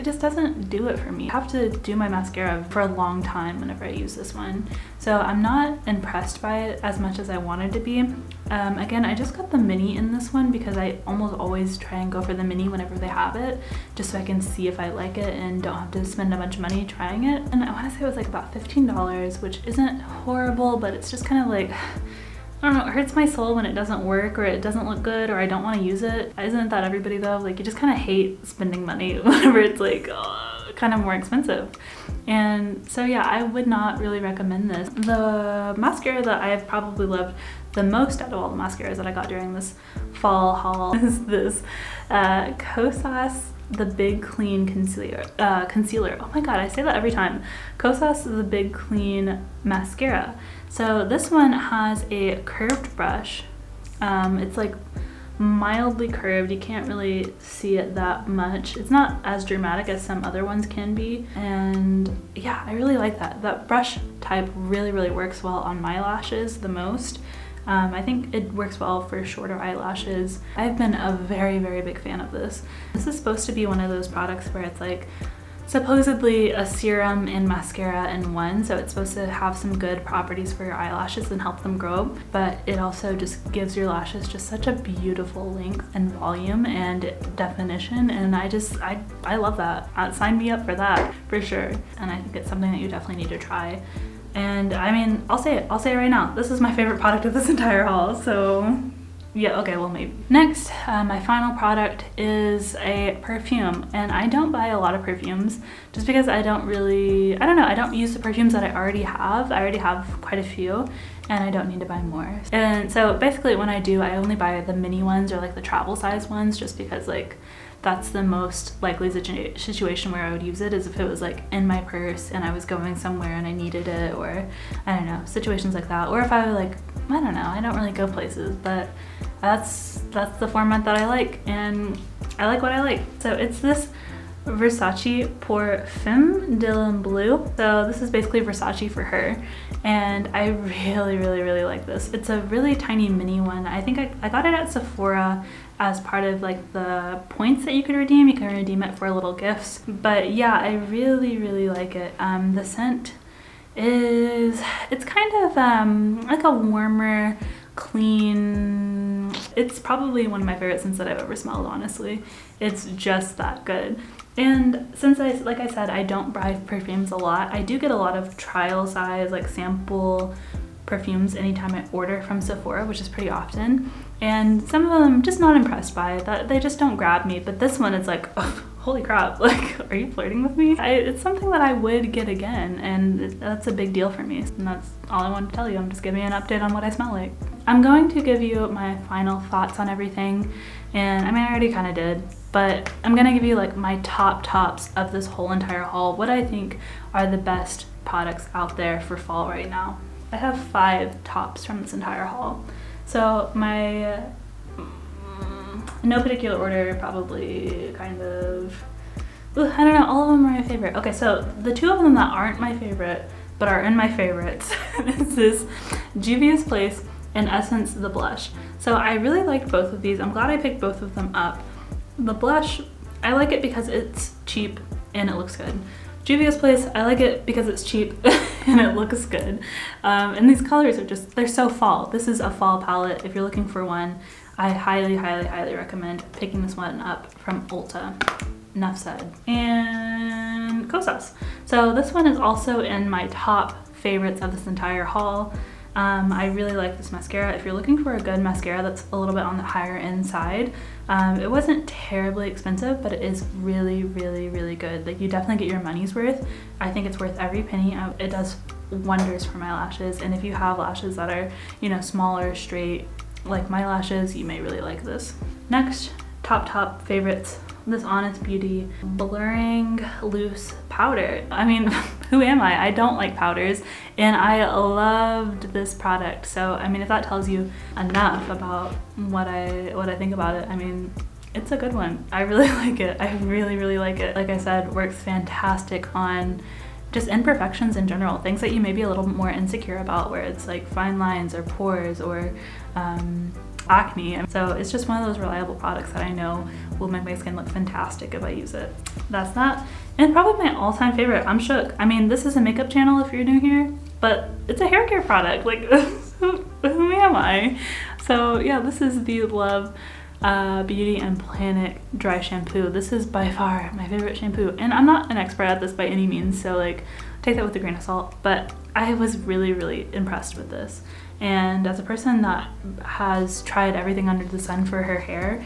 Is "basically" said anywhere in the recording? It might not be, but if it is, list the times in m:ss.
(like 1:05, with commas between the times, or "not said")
1:53, 2:18.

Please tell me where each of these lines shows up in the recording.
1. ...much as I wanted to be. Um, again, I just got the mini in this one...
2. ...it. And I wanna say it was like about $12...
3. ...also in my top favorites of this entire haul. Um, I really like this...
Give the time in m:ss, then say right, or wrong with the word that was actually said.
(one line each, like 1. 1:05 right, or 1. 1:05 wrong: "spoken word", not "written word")
1. 0:06 right
2. 0:17 wrong: "15", not "12"
3. 4:02 right.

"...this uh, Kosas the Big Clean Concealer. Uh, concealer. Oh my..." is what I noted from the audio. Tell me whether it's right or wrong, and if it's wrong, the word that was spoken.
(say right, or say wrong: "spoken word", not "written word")
right.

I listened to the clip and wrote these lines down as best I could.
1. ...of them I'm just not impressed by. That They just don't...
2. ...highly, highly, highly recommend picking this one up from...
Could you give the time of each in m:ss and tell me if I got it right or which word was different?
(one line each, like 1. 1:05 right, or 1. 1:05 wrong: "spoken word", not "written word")
1. 2:54 right
2. 3:54 right.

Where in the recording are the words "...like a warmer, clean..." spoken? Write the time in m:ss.
2:36.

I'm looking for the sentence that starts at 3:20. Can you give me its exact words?
I have five tops from this entire haul.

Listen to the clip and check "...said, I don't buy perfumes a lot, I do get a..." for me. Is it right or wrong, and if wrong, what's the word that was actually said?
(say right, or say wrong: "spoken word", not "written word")
right.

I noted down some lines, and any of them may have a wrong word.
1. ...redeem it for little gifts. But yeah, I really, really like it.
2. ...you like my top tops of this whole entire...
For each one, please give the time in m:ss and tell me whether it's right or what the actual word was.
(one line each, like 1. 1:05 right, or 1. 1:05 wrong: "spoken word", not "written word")
1. 2:28 right
2. 3:13 right.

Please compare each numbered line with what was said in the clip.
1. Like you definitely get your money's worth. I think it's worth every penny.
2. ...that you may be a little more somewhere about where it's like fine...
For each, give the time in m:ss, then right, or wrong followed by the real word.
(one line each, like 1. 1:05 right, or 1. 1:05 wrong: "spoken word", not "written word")
1. 4:15 right
2. 4:48 wrong: "insecure", not "somewhere".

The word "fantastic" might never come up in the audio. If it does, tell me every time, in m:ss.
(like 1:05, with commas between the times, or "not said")
4:45, 4:57.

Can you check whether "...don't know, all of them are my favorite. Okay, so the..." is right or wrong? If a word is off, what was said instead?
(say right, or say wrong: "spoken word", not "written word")
right.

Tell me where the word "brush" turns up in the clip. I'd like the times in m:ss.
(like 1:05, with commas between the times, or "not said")
0:52, 1:03.